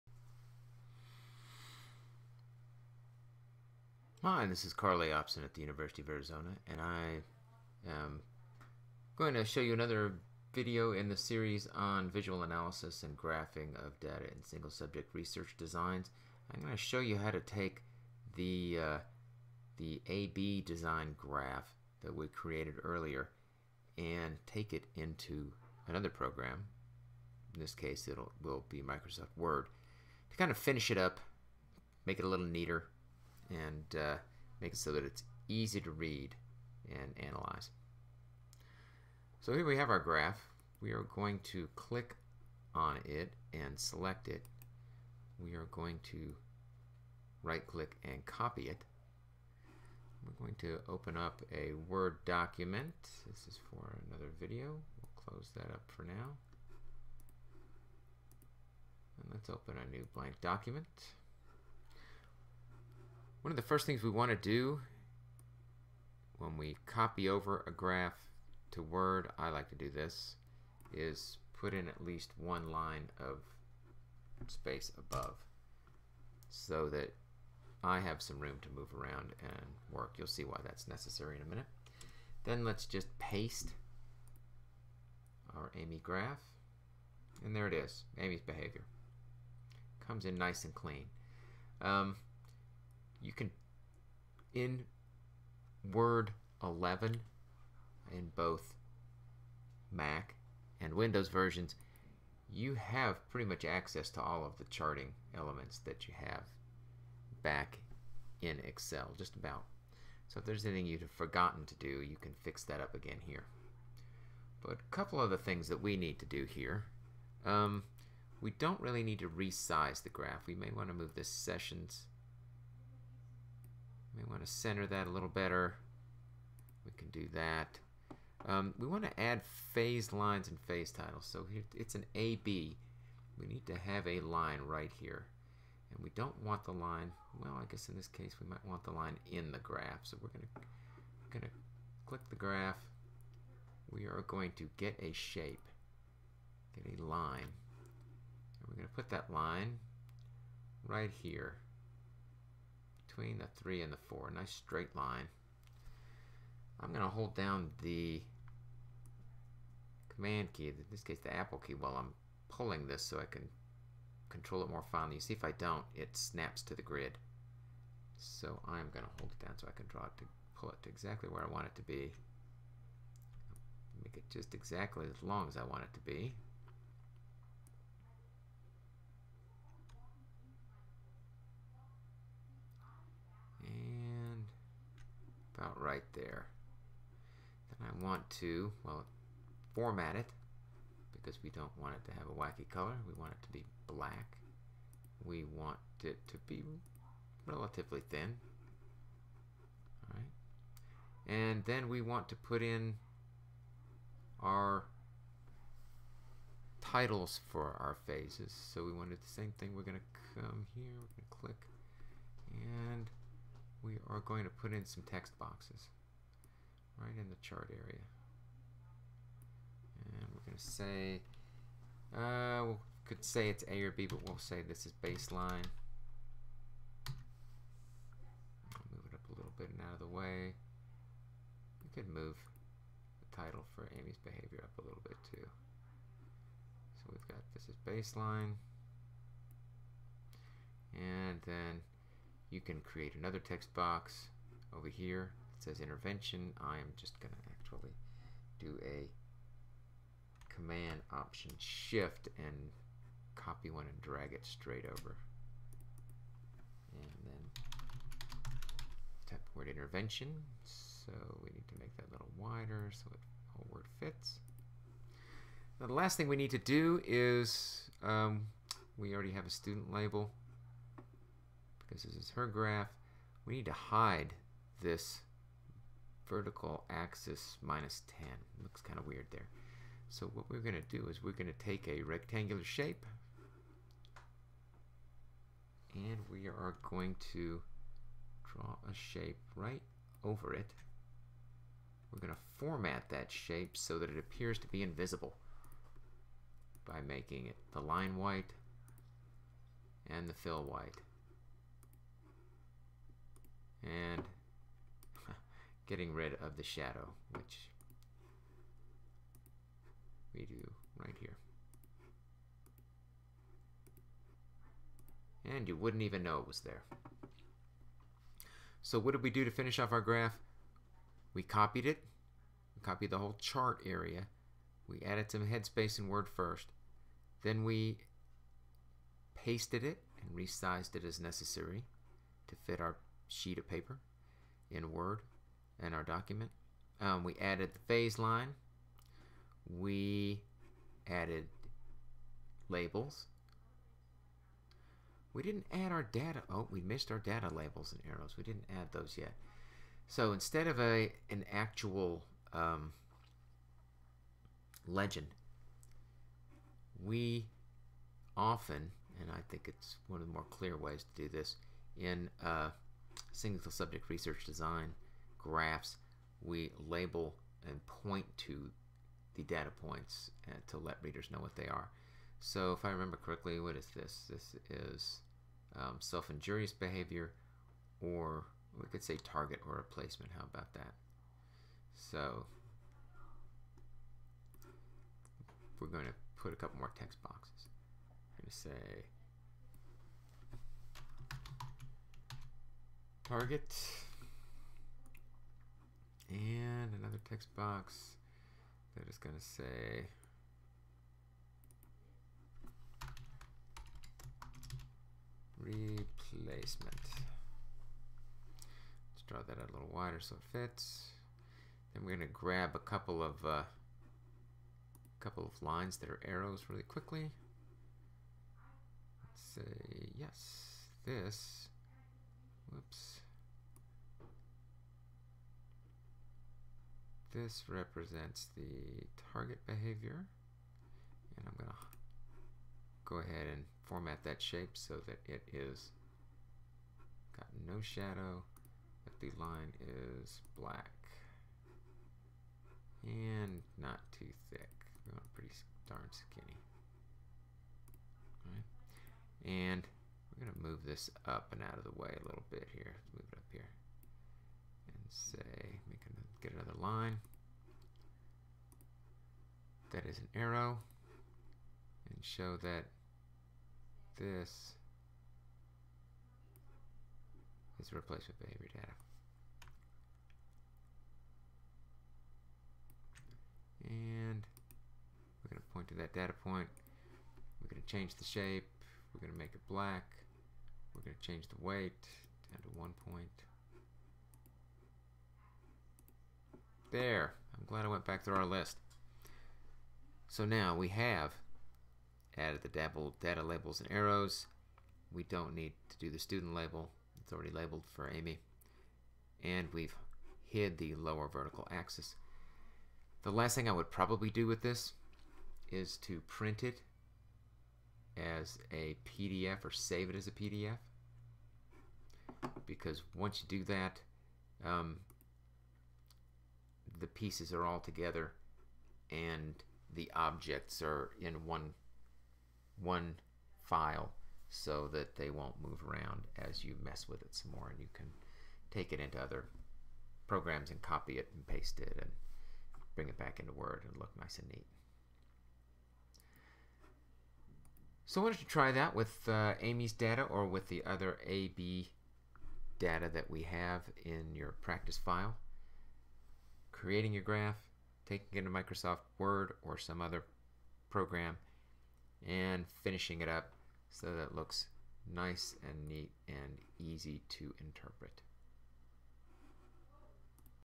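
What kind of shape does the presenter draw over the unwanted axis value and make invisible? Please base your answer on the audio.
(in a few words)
rectangular shape.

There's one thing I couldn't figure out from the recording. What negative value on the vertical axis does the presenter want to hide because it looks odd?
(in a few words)
minus 10.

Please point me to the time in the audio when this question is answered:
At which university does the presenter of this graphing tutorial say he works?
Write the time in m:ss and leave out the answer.
0:05.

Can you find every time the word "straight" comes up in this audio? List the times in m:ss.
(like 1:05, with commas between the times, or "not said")
2:34, 4:14.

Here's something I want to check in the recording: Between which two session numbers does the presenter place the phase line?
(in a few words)
3 and 4.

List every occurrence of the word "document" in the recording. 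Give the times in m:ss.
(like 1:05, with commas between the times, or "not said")
0:52, 1:00, 5:36.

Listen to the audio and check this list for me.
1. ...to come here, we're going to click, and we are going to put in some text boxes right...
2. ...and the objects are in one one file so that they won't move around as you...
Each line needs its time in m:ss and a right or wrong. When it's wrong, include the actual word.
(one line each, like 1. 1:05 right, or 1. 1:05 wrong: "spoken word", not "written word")
1. 3:29 right
2. 8:39 right.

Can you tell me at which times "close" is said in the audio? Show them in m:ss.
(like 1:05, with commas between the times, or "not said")
0:55.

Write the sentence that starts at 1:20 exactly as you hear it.
You'll see why that's necessary in a minute.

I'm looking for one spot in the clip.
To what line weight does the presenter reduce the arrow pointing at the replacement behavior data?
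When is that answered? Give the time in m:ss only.
8:02.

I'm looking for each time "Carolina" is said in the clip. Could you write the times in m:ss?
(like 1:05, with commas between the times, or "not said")
not said.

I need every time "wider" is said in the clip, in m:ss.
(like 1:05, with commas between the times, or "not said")
4:22, 6:49.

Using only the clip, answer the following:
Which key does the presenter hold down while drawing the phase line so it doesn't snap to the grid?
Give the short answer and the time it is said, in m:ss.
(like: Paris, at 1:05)
command key, at 2:40.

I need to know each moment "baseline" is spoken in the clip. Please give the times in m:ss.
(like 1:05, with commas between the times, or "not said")
3:45, 3:57.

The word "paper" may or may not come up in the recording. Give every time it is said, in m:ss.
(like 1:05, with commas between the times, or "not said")
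5:33.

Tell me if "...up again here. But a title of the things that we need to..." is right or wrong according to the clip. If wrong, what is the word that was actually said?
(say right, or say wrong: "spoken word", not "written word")
wrong: "couple", not "title".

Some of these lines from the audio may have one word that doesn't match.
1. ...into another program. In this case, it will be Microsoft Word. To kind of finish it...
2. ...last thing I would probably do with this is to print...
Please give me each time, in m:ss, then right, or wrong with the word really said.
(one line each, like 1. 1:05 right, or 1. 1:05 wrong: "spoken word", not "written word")
1. 0:24 right
2. 8:23 right.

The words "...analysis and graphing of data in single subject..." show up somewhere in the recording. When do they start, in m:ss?
0:12.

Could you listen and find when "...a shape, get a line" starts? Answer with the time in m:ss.
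2:25.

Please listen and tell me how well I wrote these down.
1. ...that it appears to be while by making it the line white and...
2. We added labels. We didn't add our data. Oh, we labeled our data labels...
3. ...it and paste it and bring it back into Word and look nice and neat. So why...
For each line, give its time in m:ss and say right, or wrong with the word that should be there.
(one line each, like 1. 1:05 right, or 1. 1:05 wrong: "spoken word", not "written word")
1. 4:53 wrong: "invisible", not "while"
2. 5:39 wrong: "missed", not "labeled"
3. 8:51 right.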